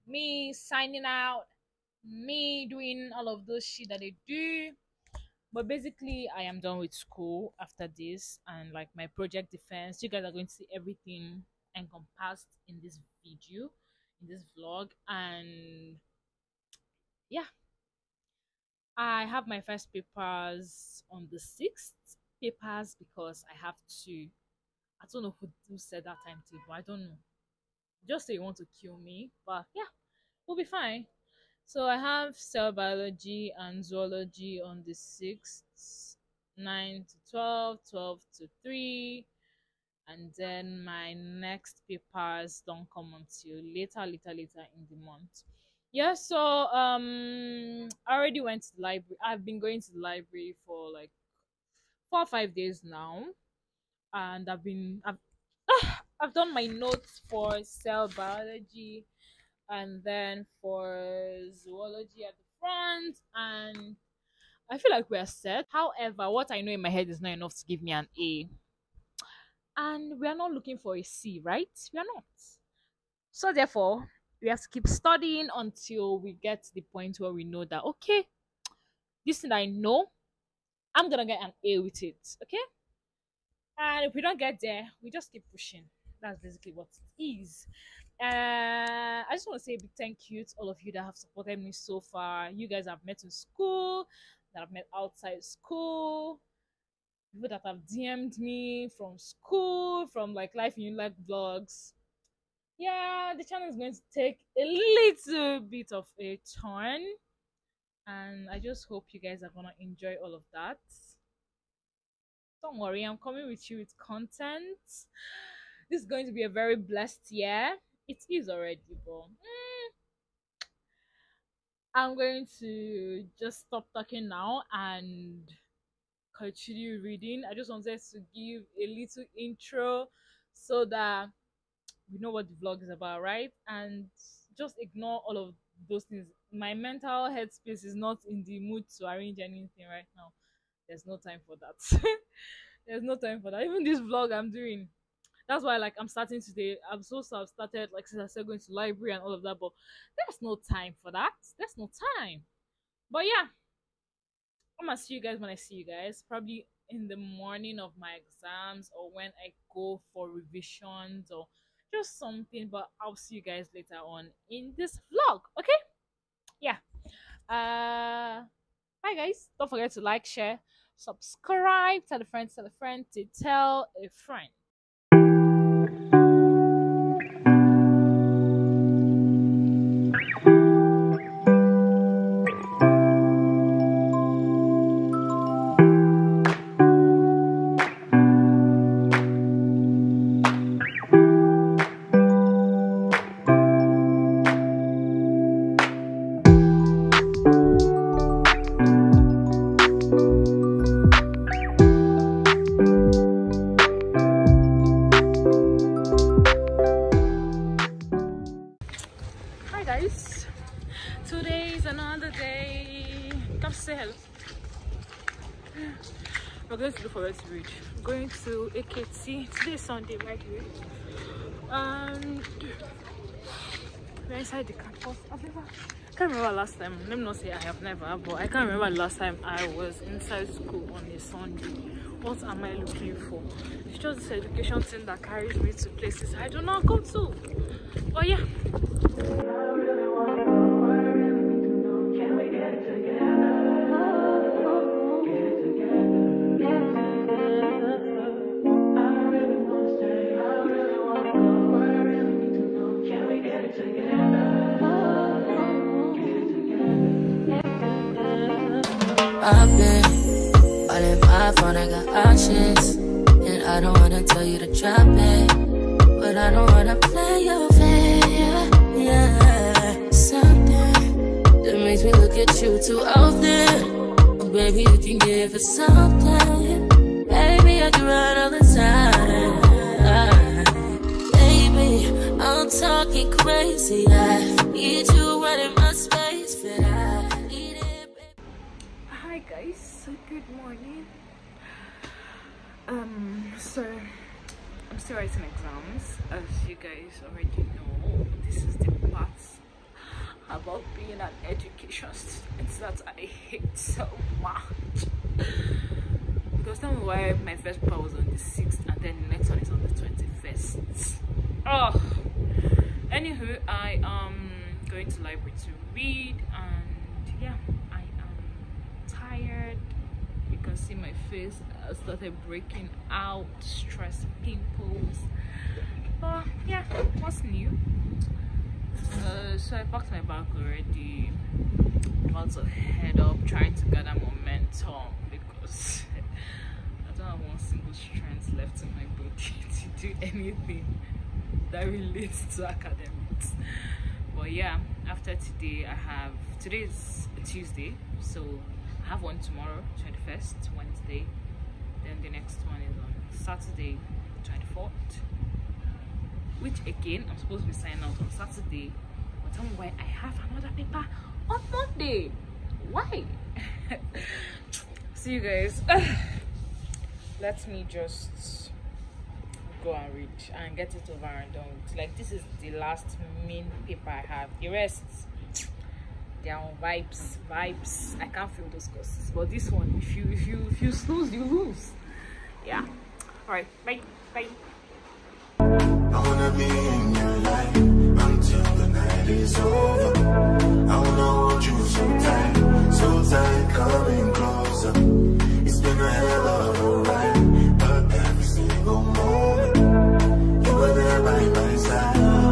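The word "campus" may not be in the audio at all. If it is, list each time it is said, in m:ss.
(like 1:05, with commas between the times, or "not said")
3:44.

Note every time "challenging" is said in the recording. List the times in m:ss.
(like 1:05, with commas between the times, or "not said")
not said.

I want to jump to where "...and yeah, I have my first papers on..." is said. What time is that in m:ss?
0:15.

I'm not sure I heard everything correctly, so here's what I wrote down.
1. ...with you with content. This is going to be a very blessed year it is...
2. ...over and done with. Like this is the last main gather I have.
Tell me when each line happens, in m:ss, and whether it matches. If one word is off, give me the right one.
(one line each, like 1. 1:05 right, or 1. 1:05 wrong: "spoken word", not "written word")
1. 1:53 right
2. 6:11 wrong: "paper", not "gather".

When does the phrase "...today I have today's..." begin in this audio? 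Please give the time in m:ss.
5:45.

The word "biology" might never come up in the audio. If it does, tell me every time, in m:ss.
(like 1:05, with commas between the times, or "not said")
0:32, 0:58.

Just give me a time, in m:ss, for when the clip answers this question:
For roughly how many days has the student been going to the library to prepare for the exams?
0:52.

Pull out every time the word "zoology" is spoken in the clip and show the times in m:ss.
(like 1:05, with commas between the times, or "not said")
0:33, 1:01.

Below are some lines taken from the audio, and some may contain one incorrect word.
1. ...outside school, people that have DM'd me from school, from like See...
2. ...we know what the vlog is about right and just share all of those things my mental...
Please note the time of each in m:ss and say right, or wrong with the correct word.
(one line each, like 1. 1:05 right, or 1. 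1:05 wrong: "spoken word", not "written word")
1. 1:34 wrong: "Life", not "See"
2. 2:12 wrong: "ignore", not "share".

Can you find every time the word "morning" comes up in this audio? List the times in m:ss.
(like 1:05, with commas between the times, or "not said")
2:37, 4:50.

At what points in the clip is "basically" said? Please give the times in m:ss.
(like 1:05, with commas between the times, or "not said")
0:05, 1:26.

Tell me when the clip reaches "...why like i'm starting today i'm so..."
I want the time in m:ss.
2:25.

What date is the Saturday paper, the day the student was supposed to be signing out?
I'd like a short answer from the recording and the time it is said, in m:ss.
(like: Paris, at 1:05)
24th, at 5:54.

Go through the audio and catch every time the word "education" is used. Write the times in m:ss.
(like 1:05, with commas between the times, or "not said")
3:54, 5:01.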